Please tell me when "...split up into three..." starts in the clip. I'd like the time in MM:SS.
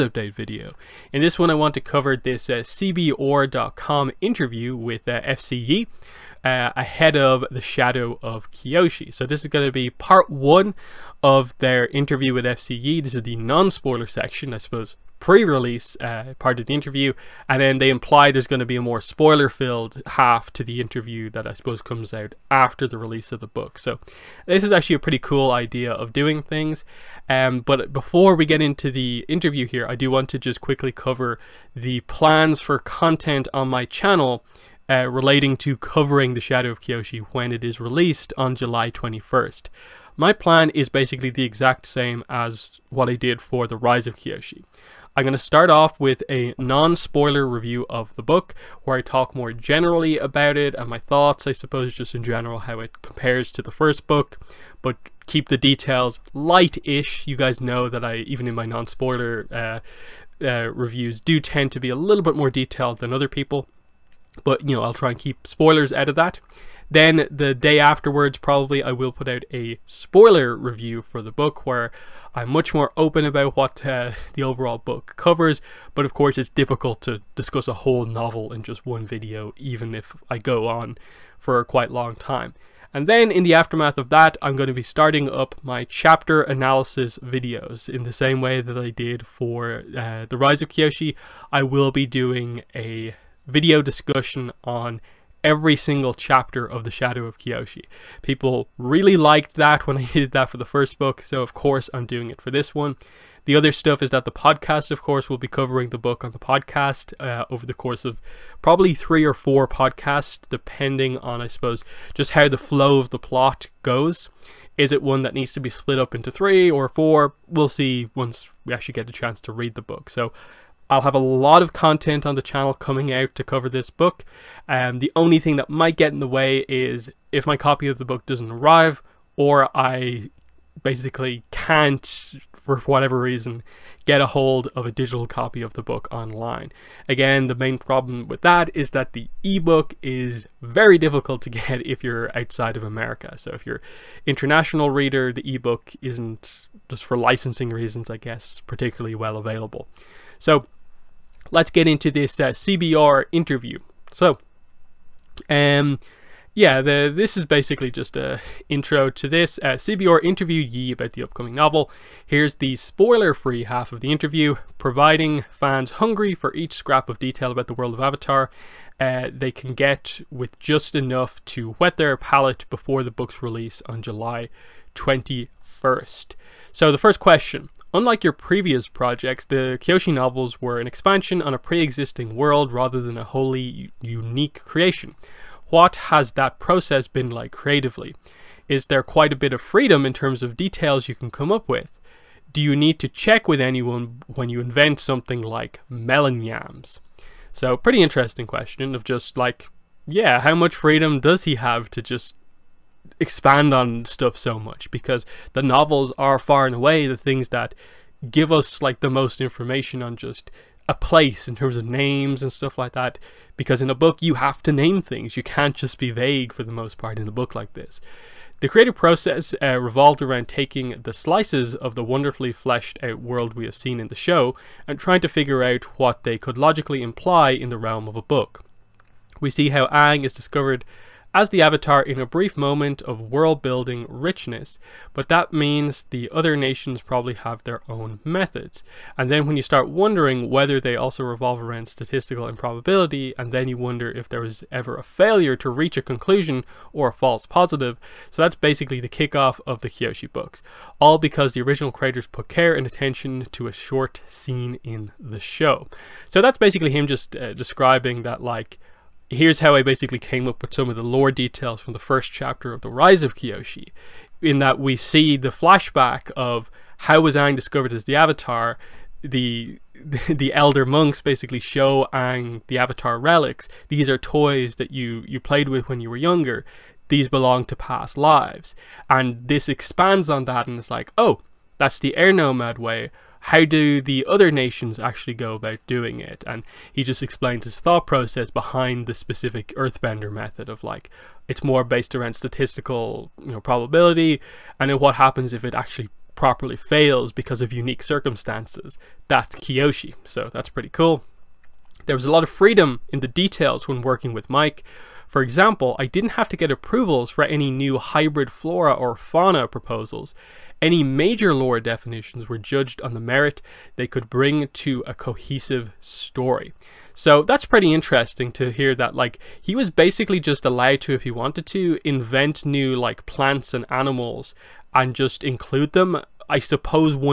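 01:55.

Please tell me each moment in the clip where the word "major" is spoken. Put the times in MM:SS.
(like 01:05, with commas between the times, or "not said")
05:11.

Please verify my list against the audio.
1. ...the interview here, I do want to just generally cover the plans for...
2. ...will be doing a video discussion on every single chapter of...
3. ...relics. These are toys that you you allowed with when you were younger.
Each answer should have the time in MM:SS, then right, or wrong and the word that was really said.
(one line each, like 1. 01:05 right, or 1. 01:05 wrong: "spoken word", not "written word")
1. 00:28 wrong: "quickly", not "generally"
2. 01:31 right
3. 04:33 wrong: "played", not "allowed".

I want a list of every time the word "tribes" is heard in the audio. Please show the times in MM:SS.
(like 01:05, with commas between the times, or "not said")
not said.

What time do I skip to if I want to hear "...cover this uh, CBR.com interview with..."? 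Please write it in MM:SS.
00:01.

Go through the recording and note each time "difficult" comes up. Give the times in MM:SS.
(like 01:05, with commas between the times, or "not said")
01:16, 02:20.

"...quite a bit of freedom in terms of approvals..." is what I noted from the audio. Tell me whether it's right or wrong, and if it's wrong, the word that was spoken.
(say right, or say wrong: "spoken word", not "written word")
wrong: "details", not "approvals".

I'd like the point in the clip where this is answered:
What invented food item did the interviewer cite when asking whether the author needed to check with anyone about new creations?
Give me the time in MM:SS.
03:15.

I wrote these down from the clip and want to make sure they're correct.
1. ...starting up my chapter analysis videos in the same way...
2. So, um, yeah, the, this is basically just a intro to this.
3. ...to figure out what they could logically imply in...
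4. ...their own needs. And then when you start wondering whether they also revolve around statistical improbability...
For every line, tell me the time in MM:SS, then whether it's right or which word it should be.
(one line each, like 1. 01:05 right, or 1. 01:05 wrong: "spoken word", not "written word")
1. 01:24 right
2. 02:34 right
3. 03:45 right
4. 03:57 wrong: "methods", not "needs".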